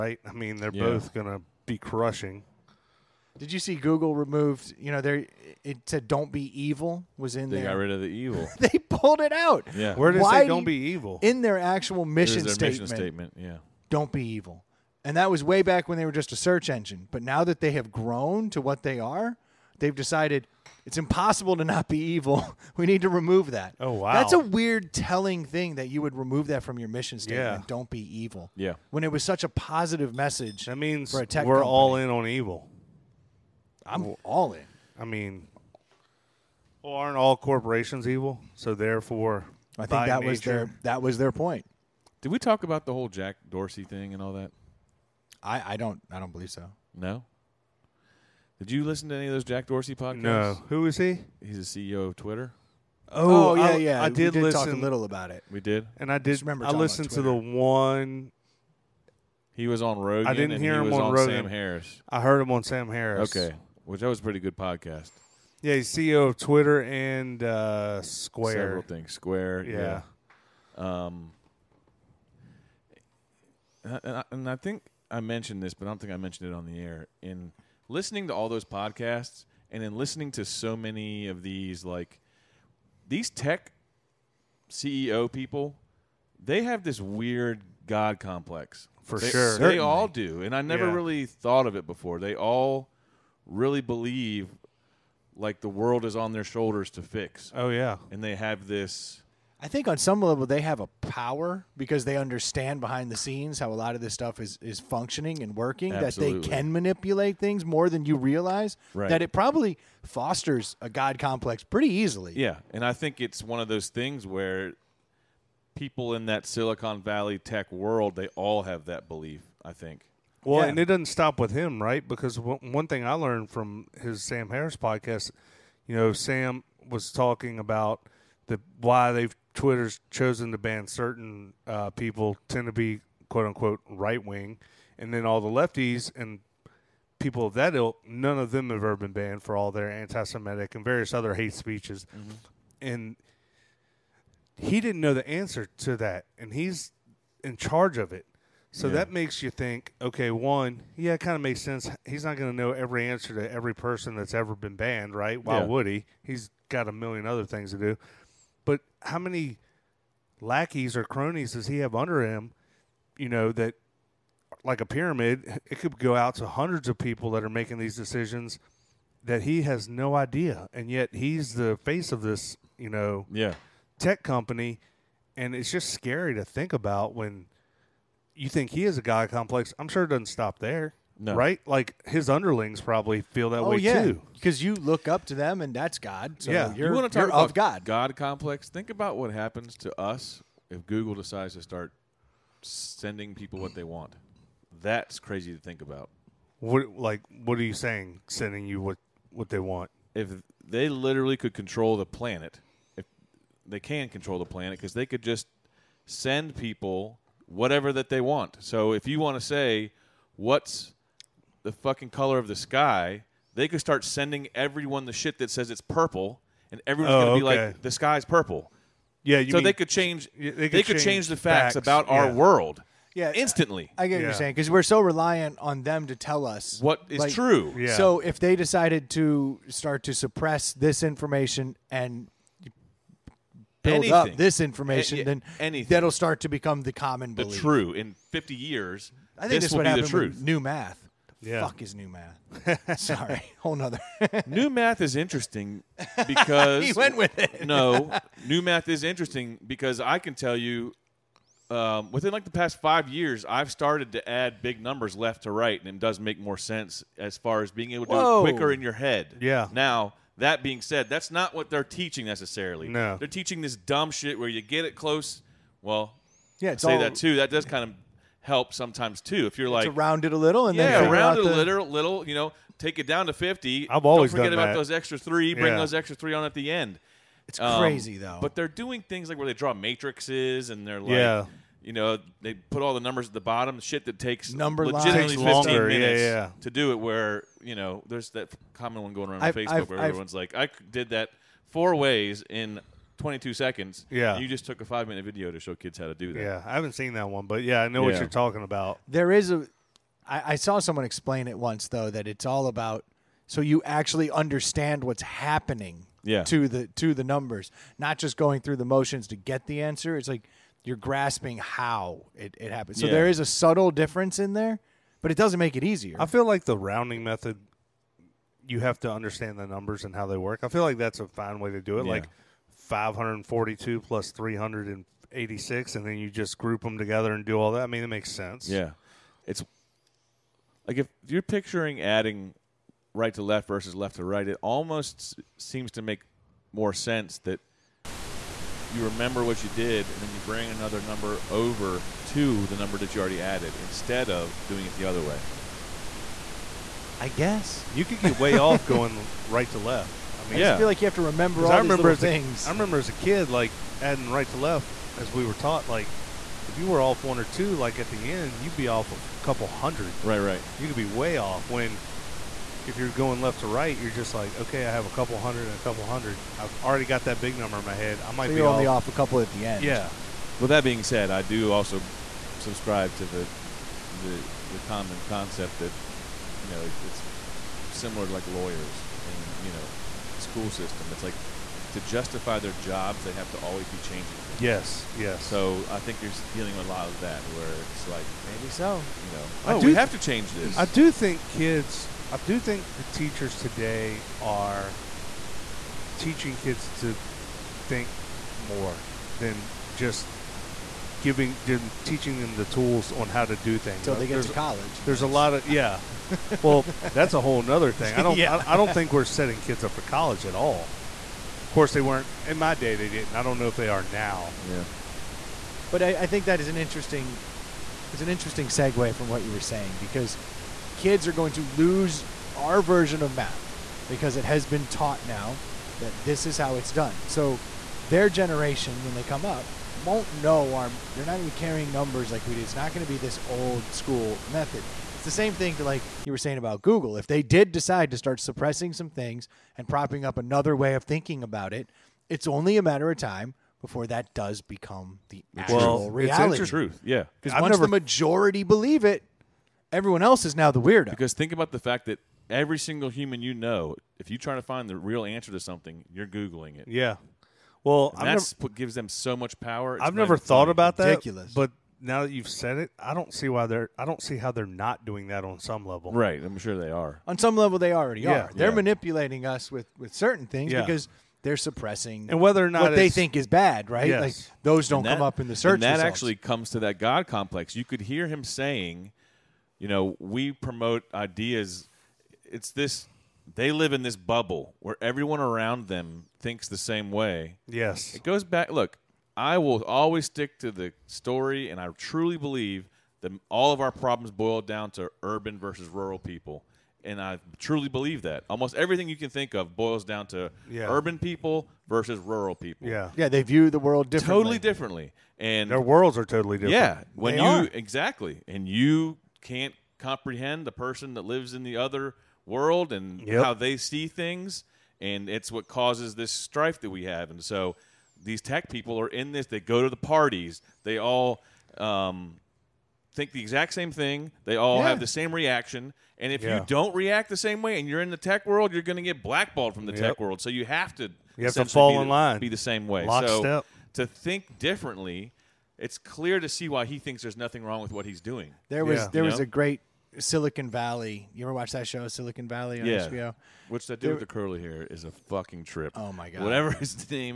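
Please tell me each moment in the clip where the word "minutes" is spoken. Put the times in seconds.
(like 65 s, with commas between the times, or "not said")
285 s, 295 s.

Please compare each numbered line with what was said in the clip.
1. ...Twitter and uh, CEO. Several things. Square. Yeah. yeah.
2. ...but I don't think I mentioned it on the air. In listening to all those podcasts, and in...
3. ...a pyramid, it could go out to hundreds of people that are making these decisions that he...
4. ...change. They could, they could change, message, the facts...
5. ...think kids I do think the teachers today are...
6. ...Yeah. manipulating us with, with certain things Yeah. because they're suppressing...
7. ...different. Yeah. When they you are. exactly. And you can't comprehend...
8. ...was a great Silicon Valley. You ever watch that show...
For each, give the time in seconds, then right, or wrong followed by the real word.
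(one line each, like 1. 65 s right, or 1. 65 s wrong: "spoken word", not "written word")
1. 66 s wrong: "Square", not "CEO"
2. 75 s right
3. 164 s right
4. 219 s wrong: "change", not "message"
5. 391 s right
6. 468 s right
7. 506 s right
8. 539 s right.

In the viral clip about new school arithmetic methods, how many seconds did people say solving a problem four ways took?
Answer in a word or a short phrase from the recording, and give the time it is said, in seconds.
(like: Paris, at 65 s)
22, at 293 s.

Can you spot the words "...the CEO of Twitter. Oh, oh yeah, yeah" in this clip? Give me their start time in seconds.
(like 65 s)
51 s.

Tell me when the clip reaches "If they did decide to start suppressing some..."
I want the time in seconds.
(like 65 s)
437 s.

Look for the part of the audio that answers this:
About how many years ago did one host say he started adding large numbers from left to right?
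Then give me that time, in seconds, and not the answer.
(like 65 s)
252 s.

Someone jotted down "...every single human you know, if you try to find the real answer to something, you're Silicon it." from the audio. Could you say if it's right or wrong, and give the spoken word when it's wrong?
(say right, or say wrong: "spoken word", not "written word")
wrong: "Googling", not "Silicon".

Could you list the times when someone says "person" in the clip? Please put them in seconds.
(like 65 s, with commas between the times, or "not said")
153 s, 510 s.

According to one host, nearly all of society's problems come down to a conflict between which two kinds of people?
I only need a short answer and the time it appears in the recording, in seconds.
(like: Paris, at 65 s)
Urban versus rural, at 495 s.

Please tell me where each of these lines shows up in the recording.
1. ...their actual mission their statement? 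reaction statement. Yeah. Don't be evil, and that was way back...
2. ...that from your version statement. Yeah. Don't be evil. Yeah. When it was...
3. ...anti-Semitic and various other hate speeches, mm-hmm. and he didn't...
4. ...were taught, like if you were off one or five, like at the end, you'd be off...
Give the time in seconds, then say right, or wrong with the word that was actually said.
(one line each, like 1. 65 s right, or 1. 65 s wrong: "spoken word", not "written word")
1. 11 s wrong: "mission", not "reaction"
2. 26 s wrong: "mission", not "version"
3. 139 s right
4. 355 s wrong: "two", not "five".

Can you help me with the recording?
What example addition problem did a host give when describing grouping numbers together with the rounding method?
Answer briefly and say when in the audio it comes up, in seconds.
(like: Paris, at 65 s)
542 plus 386, at 322 s.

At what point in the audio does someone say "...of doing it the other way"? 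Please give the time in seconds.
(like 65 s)
344 s.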